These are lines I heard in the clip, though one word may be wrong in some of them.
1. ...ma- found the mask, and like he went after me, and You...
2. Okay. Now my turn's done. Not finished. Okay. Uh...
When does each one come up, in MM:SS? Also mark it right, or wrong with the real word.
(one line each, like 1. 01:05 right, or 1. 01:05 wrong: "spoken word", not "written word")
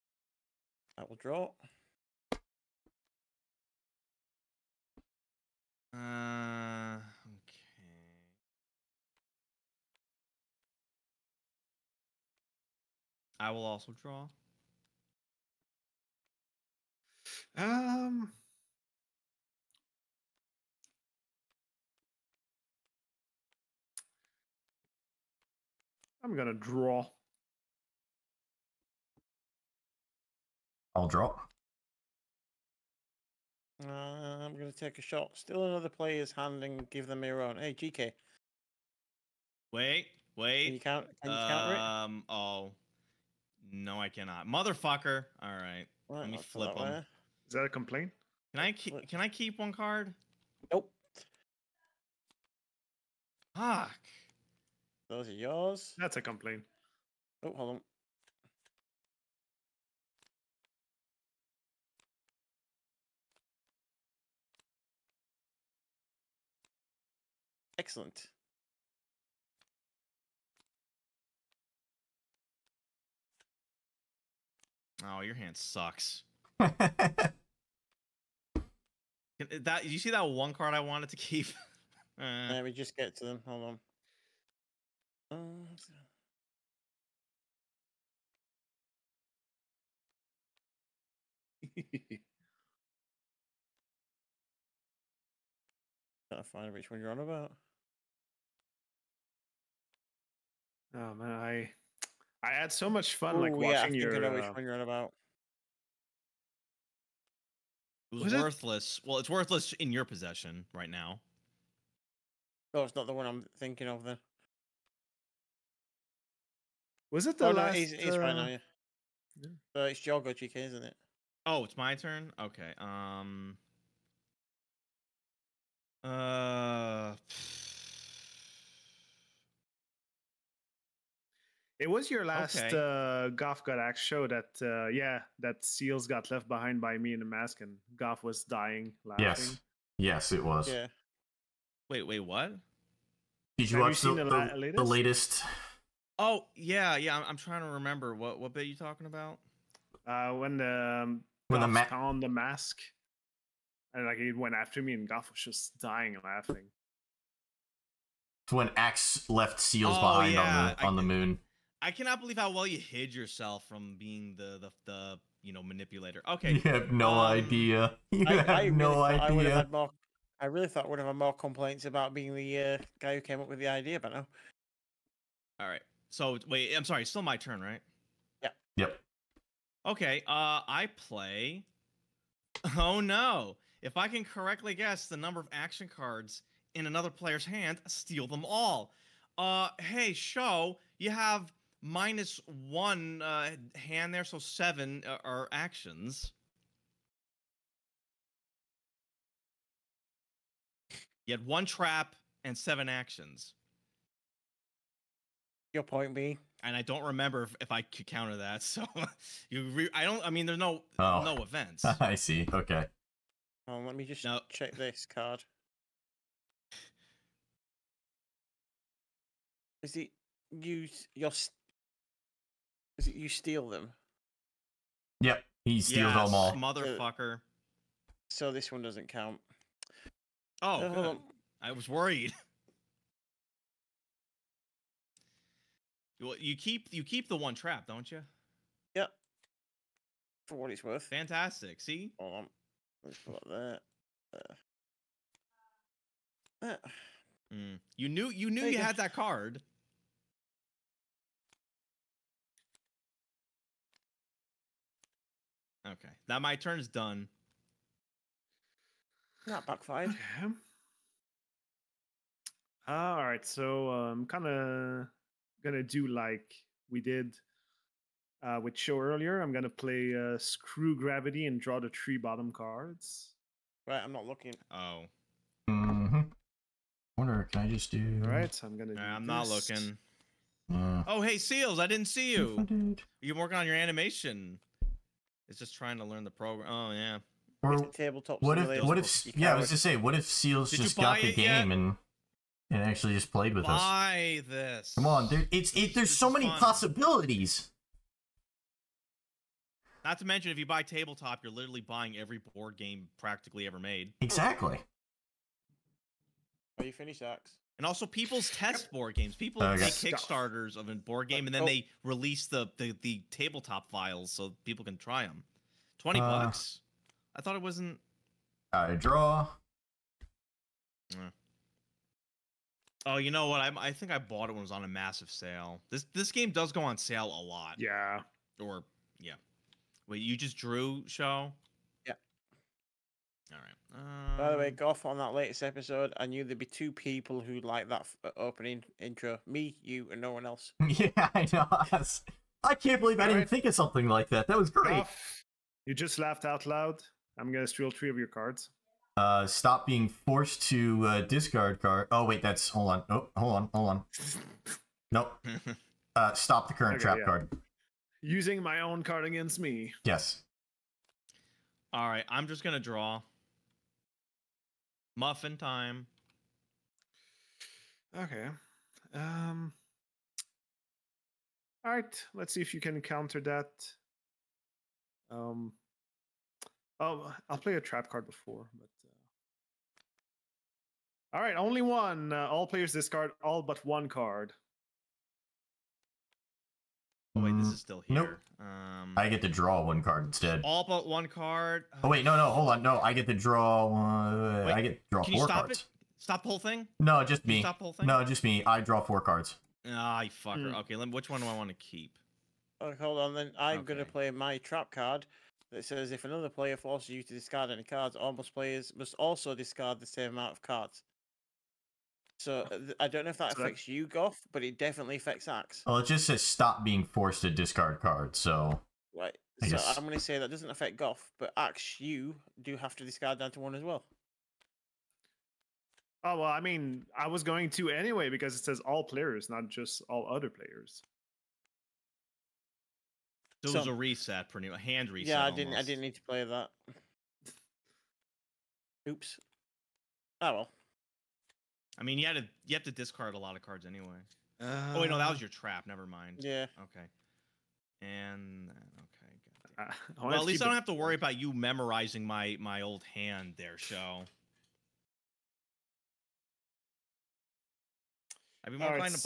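1. 02:31 wrong: "Goff", not "You"
2. 04:15 wrong: "backfired", not "finished".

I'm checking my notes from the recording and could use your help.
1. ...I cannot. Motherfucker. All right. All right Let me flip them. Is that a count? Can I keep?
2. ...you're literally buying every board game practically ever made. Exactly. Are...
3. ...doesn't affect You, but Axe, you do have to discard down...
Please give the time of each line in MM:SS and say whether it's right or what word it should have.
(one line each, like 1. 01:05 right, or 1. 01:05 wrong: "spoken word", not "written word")
1. 00:43 wrong: "complaint", not "count"
2. 05:01 right
3. 07:00 wrong: "Goff", not "You".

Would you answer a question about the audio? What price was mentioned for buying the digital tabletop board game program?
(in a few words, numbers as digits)
$20.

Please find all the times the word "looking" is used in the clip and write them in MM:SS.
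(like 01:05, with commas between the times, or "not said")
04:34, 04:39.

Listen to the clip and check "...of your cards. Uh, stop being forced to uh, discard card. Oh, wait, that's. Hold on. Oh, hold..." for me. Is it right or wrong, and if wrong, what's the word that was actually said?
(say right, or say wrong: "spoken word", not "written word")
right.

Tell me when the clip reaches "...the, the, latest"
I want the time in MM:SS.
02:24.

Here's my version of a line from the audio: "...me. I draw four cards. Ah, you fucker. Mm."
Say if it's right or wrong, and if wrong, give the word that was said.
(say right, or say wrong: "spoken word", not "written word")
right.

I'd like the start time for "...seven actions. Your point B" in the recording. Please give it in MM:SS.
03:22.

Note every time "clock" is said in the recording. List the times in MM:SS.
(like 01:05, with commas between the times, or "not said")
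not said.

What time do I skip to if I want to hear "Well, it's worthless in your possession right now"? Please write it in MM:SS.
01:49.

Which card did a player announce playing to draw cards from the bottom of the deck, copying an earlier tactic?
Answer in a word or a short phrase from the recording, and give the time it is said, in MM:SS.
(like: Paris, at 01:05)
Screw Gravity, at 04:30.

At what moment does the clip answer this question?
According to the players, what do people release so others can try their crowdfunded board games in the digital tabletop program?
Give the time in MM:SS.
05:13.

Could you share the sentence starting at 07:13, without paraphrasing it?
So, so it was a reset, pretty much, hand reset.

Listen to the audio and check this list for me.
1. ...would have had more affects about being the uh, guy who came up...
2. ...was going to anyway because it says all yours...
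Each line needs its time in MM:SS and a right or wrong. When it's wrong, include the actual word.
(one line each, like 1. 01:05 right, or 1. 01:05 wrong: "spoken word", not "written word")
1. 02:50 wrong: "complaints", not "affects"
2. 07:07 wrong: "players", not "yours".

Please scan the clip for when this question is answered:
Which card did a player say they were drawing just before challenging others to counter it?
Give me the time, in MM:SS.
06:05.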